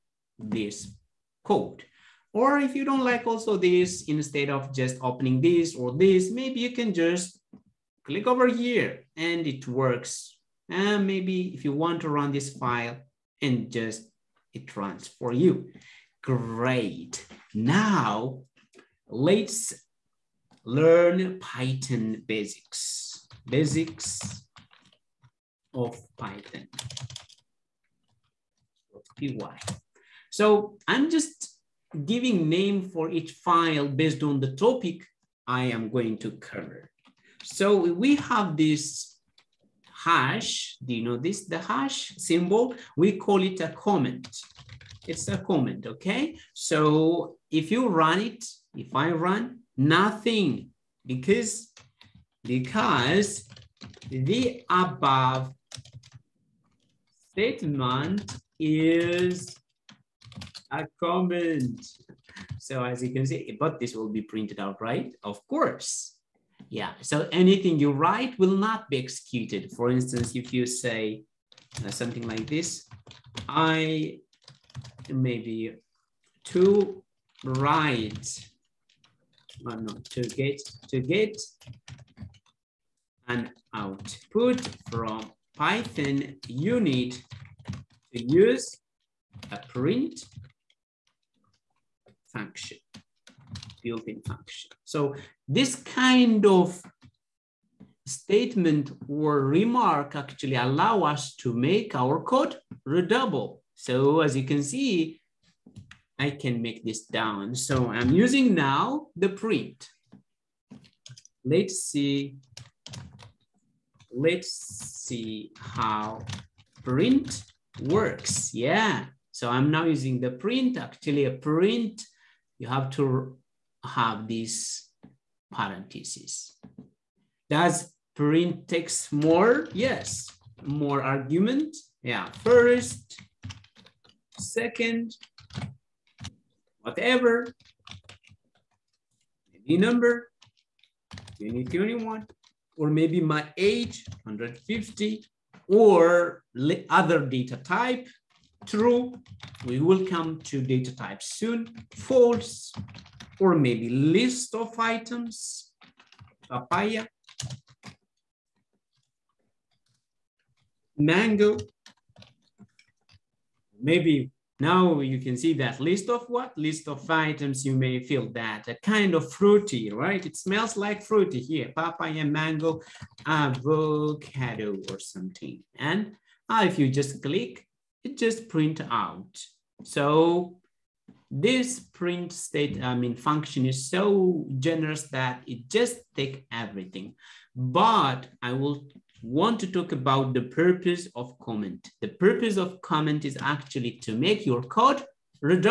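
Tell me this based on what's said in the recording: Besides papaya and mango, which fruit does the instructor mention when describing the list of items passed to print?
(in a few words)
Avocado.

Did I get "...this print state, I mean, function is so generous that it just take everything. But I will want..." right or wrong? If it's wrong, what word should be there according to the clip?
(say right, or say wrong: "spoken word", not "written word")
right.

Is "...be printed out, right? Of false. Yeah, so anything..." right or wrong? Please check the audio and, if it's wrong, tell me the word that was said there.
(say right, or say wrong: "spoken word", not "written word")
wrong: "course", not "false".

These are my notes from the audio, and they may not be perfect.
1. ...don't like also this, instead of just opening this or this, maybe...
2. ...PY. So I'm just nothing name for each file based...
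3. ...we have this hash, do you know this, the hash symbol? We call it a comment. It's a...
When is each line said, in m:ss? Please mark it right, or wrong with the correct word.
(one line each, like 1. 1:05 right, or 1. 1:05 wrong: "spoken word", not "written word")
1. 0:02 right
2. 0:29 wrong: "giving", not "nothing"
3. 0:38 right.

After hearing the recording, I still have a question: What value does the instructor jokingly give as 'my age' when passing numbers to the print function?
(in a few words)
150.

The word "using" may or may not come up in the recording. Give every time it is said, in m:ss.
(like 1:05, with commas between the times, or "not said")
1:48, 1:59.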